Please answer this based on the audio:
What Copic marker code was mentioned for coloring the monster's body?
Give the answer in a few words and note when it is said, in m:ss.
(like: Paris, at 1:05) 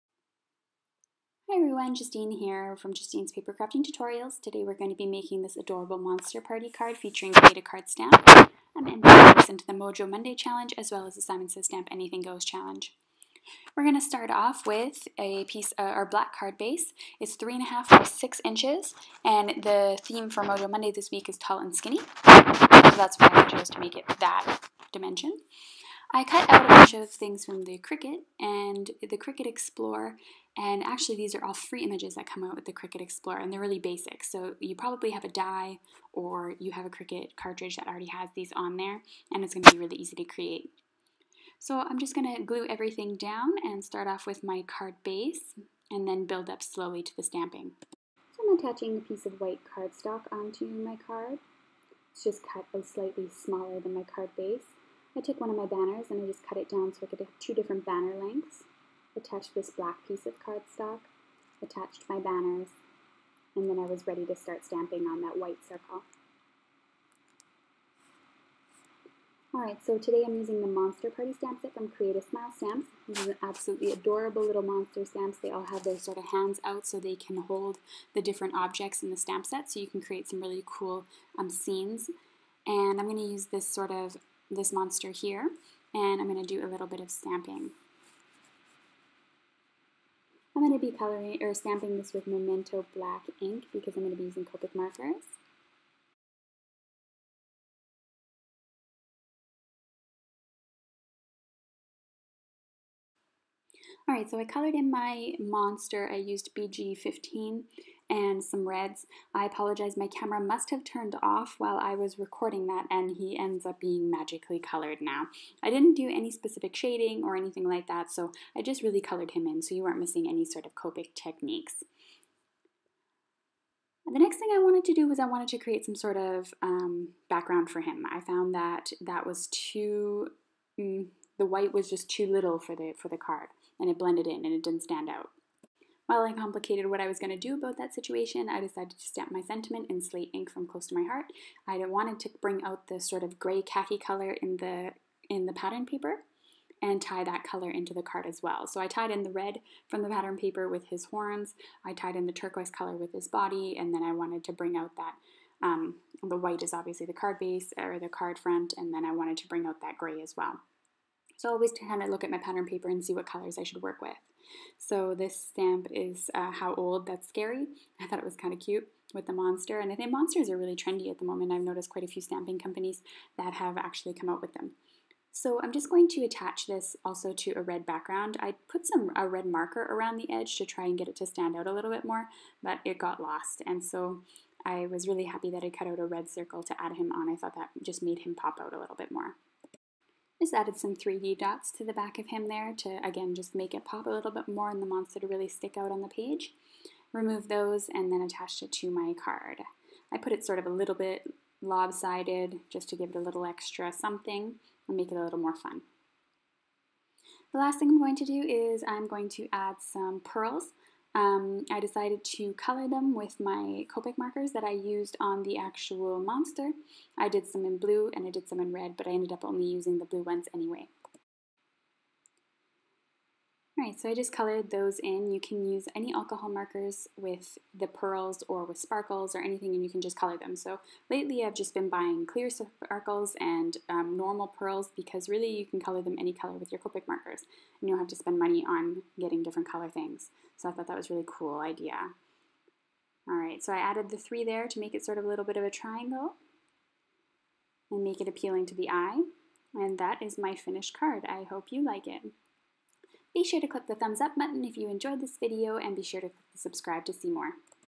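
BG15, at 1:46.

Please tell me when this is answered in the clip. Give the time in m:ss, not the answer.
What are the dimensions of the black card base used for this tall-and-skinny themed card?
0:17.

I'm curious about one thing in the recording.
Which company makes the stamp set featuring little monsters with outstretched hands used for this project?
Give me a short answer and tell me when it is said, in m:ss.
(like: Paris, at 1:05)
Create a Smile Stamps, at 1:11.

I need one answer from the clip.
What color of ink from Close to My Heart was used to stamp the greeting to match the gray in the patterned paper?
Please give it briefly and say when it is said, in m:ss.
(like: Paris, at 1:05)
Slate, at 2:20.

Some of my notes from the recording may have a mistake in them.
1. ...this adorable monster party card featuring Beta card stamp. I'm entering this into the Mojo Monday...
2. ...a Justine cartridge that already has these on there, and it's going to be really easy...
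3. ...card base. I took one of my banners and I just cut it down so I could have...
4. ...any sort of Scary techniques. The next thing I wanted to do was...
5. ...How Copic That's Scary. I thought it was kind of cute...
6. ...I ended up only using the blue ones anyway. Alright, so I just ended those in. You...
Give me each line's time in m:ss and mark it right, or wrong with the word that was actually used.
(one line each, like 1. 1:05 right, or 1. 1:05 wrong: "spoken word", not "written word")
1. 0:05 right
2. 0:36 wrong: "Cricut", not "Justine"
3. 0:54 right
4. 2:00 wrong: "Copic", not "Scary"
5. 2:46 wrong: "Old", not "Copic"
6. 3:39 wrong: "colored", not "ended".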